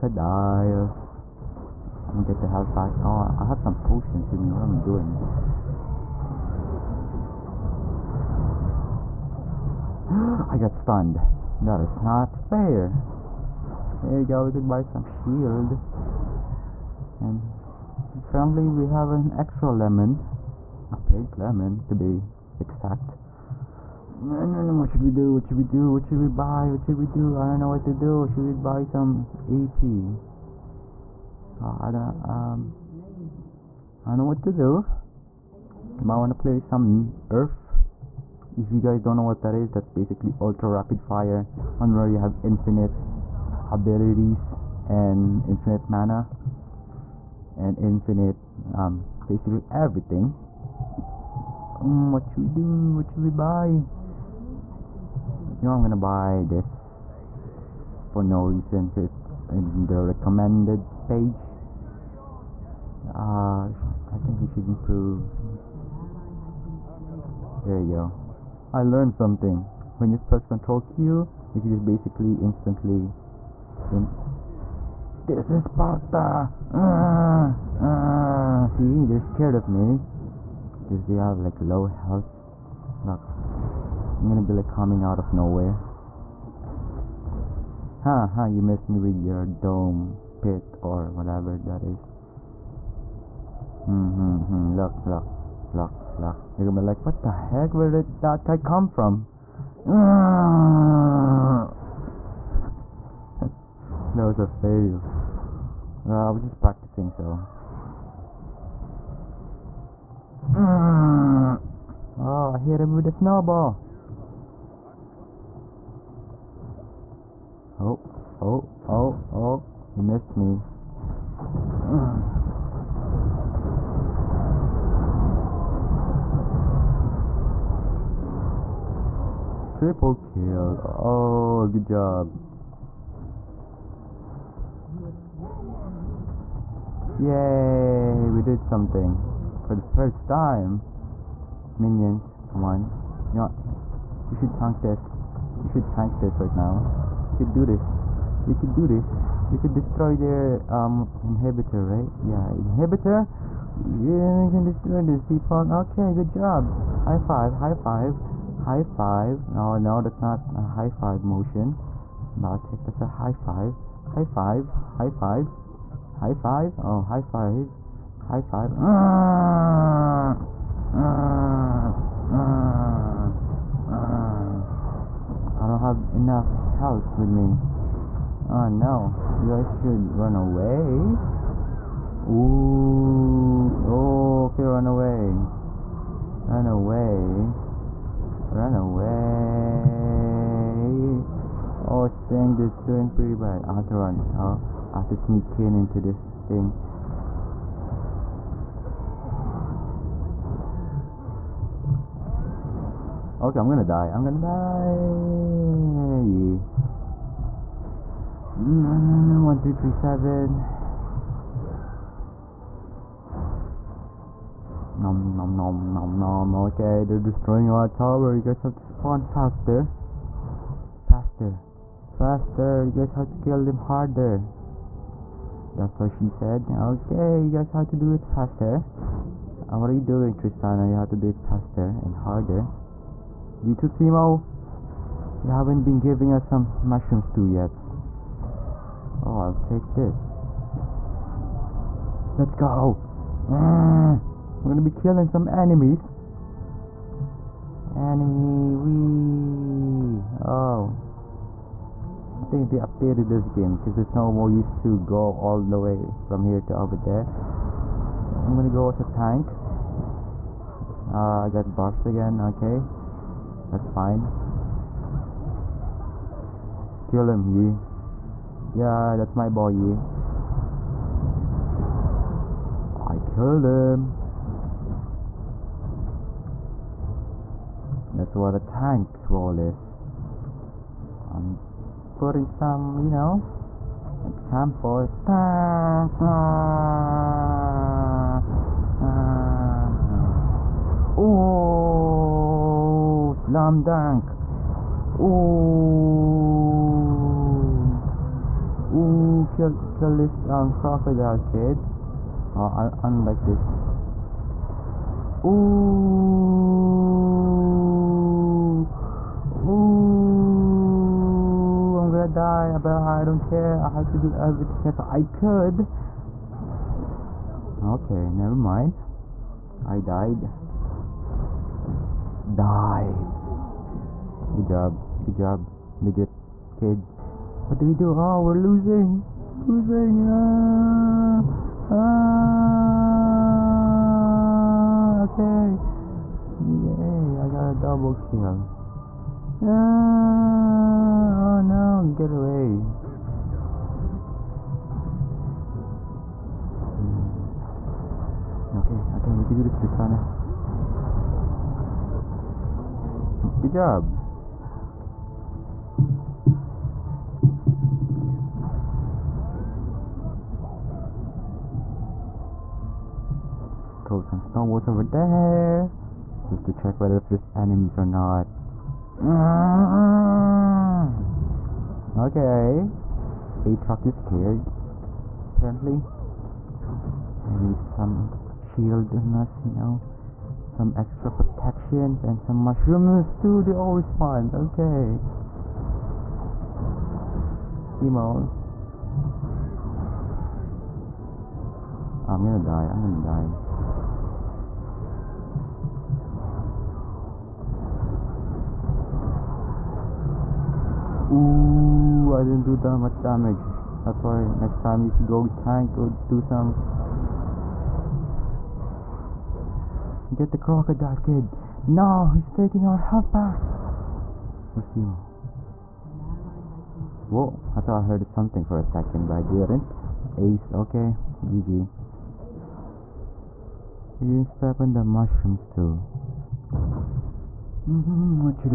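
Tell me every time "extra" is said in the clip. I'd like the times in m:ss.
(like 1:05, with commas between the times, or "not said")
0:19, 6:20.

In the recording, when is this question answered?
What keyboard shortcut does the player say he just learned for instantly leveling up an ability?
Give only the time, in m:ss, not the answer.
1:10.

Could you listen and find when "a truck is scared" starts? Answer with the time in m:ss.
6:13.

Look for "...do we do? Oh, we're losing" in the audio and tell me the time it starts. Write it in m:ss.
5:27.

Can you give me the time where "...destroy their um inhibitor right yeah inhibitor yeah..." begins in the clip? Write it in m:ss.
2:29.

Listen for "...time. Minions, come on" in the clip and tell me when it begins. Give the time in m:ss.
2:20.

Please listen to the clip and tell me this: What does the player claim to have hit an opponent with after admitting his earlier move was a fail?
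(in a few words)
a snowball.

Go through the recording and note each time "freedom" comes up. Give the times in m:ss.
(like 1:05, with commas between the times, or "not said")
not said.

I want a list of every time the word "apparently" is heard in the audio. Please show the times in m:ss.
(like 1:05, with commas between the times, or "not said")
0:18, 6:15.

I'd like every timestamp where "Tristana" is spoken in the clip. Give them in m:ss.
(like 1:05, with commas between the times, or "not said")
3:50, 5:49.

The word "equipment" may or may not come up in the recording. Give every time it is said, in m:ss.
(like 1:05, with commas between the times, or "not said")
not said.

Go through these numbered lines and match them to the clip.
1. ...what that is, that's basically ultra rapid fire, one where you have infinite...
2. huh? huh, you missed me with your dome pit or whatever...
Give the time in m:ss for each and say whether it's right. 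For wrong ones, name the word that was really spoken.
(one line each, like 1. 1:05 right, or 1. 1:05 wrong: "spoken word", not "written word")
1. 0:39 right
2. 1:28 right.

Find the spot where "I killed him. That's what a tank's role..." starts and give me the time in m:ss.
4:33.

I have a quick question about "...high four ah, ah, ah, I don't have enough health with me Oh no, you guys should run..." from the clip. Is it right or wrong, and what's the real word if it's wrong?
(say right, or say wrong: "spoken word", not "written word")
wrong: "five", not "four".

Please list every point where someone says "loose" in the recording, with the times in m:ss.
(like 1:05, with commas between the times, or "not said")
not said.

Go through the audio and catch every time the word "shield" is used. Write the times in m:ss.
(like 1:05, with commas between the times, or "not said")
0:15, 6:18.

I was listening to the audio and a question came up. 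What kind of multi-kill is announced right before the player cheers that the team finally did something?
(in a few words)
Triple kill.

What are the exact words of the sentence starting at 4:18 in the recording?
I'm gonna go as a tank.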